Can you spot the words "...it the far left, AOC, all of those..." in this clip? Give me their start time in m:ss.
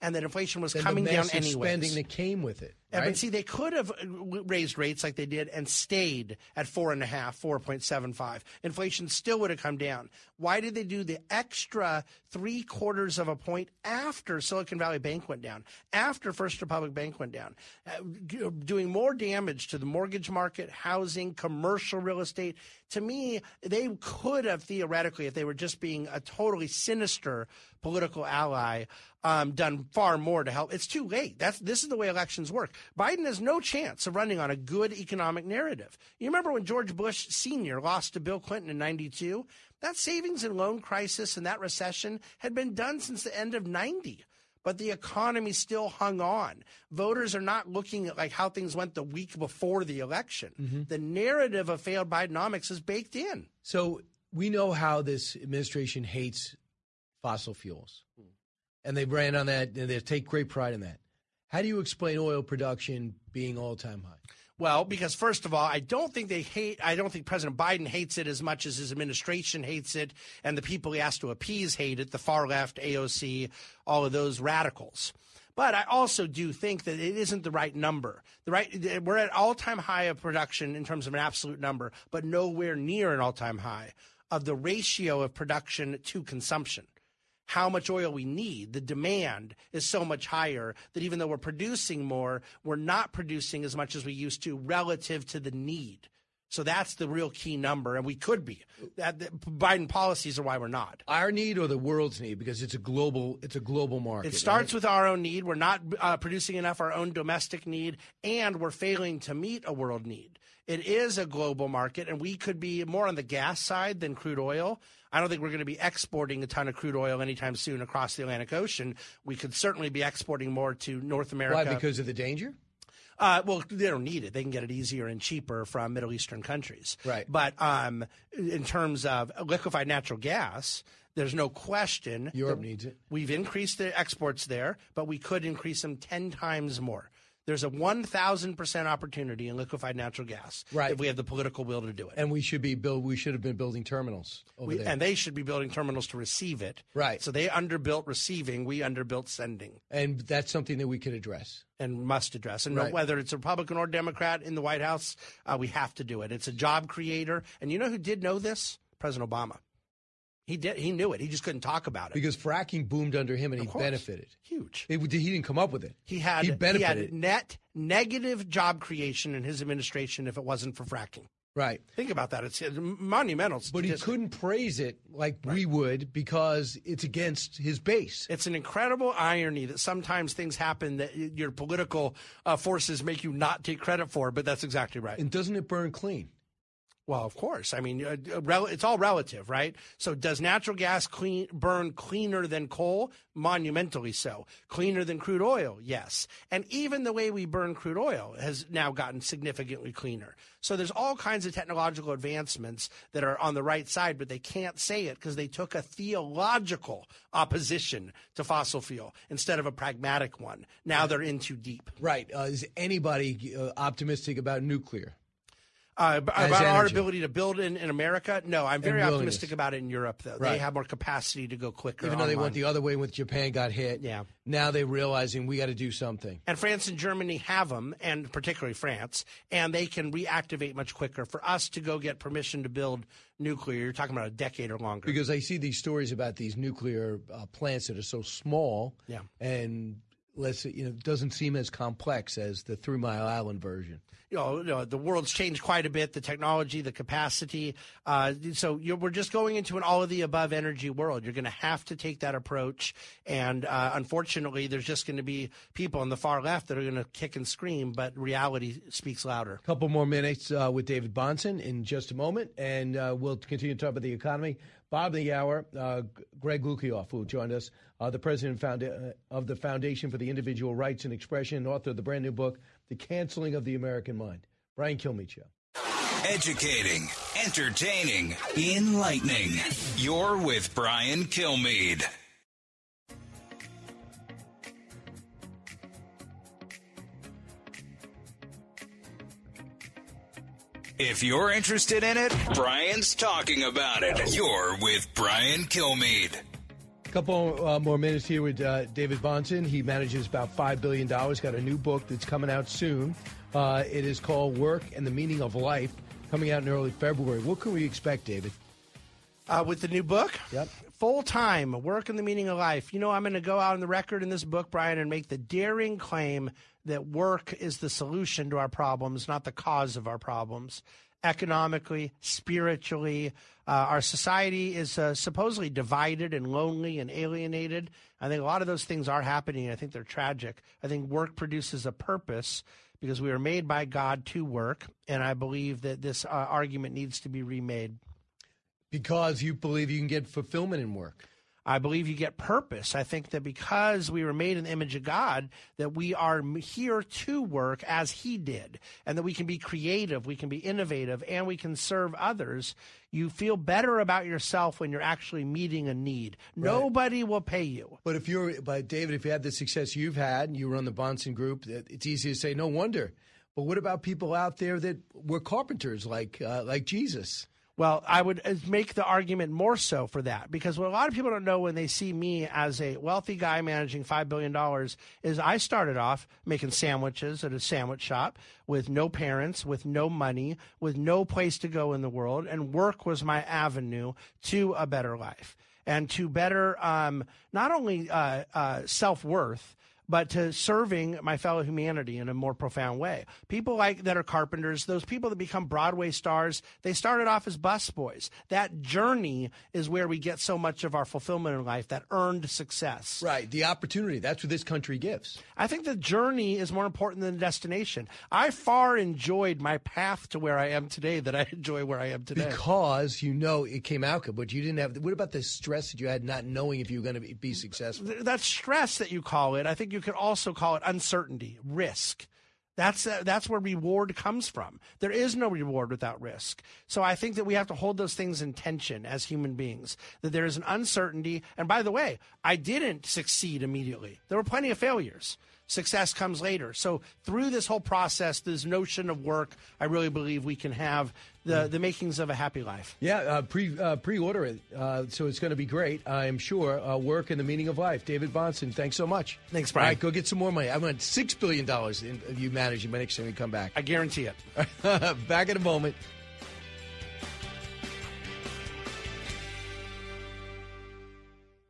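1:11.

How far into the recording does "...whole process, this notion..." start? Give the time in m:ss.
7:17.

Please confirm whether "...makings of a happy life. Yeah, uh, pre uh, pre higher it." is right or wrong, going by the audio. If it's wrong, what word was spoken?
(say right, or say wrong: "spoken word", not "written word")
wrong: "order", not "higher".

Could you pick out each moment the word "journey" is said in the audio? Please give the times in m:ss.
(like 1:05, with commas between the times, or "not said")
6:38, 6:45.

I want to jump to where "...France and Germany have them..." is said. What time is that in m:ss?
3:46.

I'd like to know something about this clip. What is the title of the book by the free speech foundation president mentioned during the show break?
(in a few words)
The Canceling of the American Mind.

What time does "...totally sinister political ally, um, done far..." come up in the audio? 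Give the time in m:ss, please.
0:26.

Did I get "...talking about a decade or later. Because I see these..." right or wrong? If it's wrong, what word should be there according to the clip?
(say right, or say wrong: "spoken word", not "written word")
wrong: "longer", not "later".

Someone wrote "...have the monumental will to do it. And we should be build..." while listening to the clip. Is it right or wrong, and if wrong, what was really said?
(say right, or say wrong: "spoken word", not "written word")
wrong: "political", not "monumental".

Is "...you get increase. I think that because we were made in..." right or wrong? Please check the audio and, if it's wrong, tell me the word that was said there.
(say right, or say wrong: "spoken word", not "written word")
wrong: "purpose", not "increase".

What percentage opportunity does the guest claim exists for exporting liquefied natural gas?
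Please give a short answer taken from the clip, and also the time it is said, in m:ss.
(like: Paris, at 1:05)
1,000%, at 2:17.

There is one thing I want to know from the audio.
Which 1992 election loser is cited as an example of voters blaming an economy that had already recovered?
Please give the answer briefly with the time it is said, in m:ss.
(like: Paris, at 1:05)
George Bush Senior, at 0:36.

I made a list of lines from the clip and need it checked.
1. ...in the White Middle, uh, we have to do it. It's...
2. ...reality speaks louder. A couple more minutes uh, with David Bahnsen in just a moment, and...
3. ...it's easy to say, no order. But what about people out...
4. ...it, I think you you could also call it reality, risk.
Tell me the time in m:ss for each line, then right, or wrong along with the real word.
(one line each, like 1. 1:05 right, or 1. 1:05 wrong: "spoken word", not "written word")
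1. 2:34 wrong: "House", not "Middle"
2. 4:18 right
3. 6:01 wrong: "wonder", not "order"
4. 6:59 wrong: "uncertainty", not "reality".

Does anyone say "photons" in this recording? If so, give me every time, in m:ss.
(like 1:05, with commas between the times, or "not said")
not said.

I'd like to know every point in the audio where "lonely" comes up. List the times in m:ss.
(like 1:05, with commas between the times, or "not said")
5:26.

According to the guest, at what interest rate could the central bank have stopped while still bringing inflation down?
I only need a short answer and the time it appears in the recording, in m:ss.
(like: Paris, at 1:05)
4.75, at 0:07.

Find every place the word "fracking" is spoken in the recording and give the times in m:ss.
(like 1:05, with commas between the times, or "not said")
2:42, 2:50.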